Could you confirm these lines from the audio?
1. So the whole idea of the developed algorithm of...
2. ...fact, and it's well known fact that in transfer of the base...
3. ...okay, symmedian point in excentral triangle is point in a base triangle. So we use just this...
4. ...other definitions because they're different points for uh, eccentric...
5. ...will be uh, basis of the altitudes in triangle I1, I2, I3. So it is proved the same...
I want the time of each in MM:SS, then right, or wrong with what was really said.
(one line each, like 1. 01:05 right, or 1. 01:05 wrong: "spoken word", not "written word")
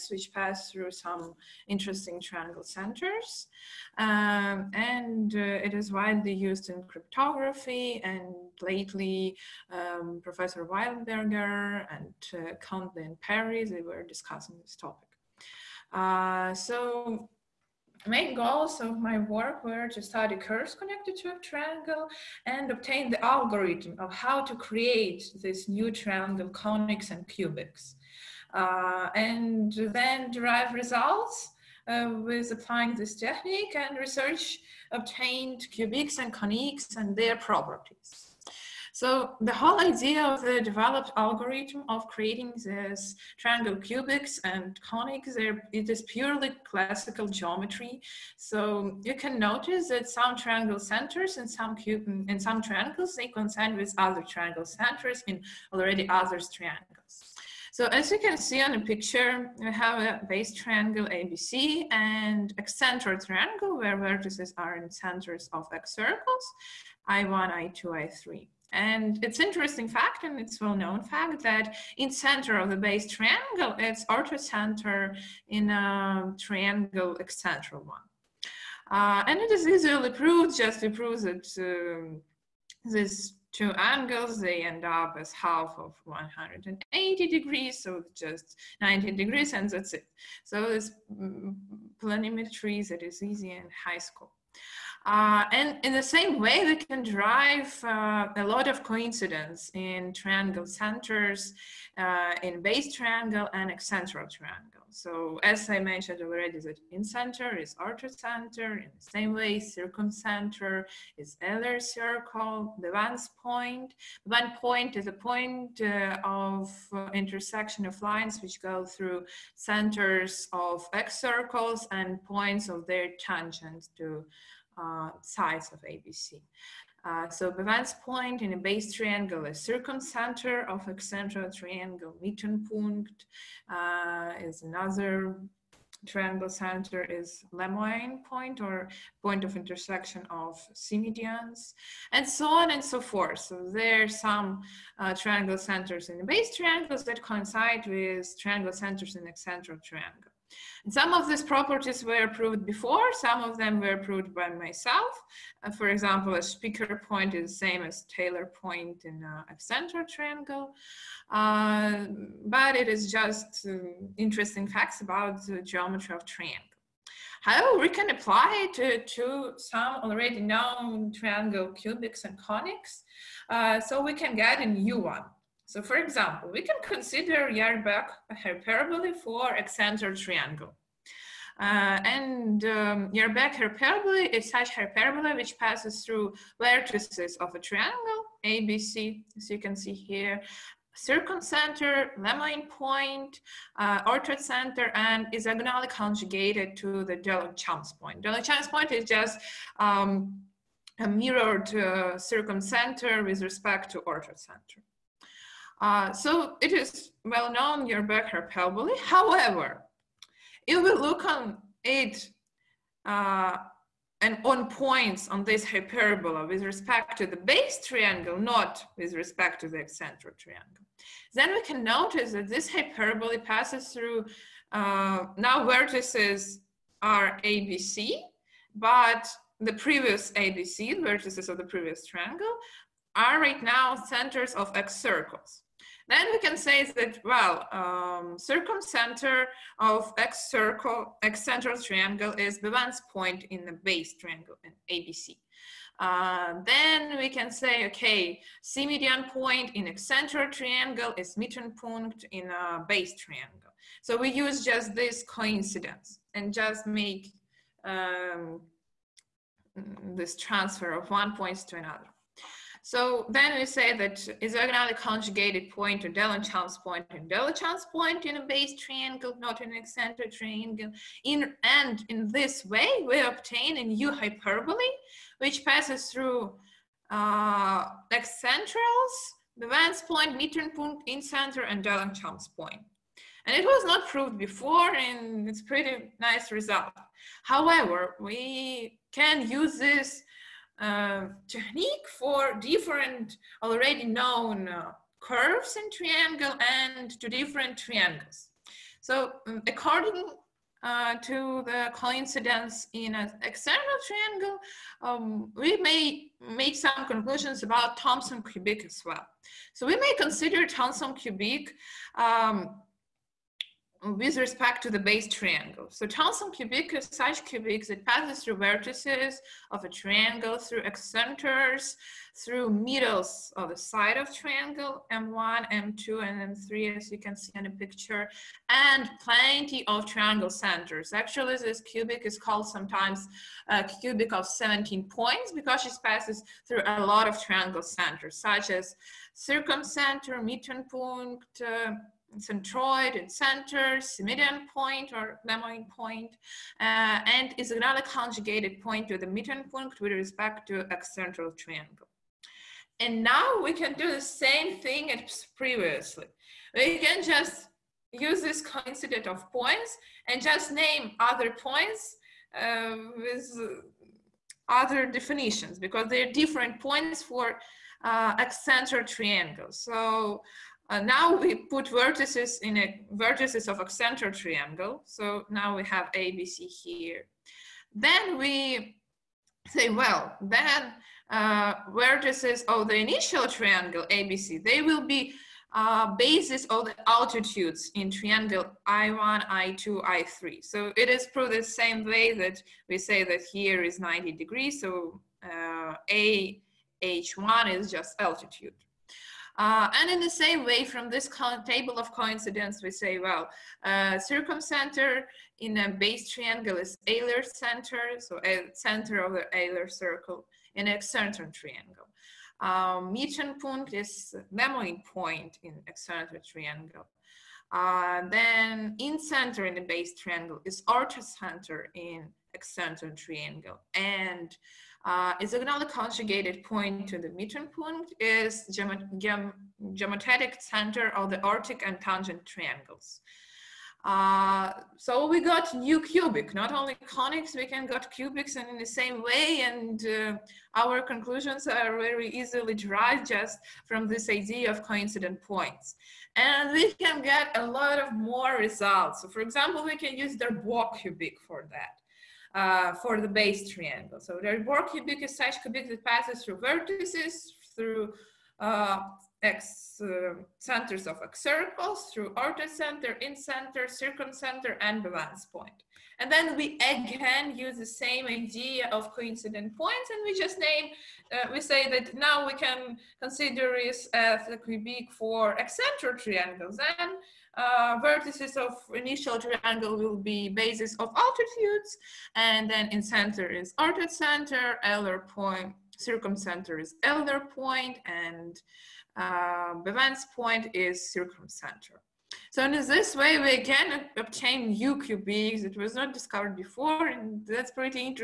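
1. 00:39 right
2. 01:09 wrong: "center", not "transfer"
3. 04:07 right
4. 06:04 right
5. 06:24 right.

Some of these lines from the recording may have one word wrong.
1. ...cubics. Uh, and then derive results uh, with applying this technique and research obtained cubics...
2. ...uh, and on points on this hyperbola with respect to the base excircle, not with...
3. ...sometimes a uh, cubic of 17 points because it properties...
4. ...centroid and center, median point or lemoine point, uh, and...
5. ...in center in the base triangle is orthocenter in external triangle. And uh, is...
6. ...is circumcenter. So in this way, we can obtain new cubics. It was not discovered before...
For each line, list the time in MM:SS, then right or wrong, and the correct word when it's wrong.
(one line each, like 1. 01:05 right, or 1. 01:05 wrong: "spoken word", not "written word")
1. 00:27 right
2. 03:33 wrong: "triangle", not "excircle"
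3. 05:32 wrong: "passes", not "properties"
4. 05:42 right
5. 06:58 right
6. 08:10 right.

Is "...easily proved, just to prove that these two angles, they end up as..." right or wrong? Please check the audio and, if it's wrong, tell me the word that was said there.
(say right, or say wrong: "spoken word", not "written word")
right.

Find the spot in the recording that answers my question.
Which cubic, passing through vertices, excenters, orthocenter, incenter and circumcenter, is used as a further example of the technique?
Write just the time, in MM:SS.
07:30.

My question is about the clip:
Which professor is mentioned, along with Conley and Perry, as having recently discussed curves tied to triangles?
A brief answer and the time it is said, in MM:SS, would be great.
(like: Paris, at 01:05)
Wildberger, at 00:10.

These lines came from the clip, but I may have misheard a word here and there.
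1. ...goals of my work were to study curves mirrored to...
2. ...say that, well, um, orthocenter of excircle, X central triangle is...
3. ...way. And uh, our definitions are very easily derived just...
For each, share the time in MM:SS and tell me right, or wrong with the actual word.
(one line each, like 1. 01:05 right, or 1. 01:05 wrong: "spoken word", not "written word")
1. 00:18 wrong: "connected", not "mirrored"
2. 03:56 wrong: "circumcenter", not "orthocenter"
3. 07:19 wrong: "conclusions", not "definitions".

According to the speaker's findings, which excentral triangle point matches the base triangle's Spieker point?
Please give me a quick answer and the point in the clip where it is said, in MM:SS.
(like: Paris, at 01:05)
Taylor point, at 02:38.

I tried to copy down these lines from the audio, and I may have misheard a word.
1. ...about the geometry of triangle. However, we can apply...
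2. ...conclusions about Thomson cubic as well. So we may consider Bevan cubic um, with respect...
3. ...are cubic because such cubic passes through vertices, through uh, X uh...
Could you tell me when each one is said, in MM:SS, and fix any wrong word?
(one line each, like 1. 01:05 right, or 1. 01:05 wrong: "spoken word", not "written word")
1. 02:45 right
2. 05:07 wrong: "Thomson", not "Bevan"
3. 07:34 right.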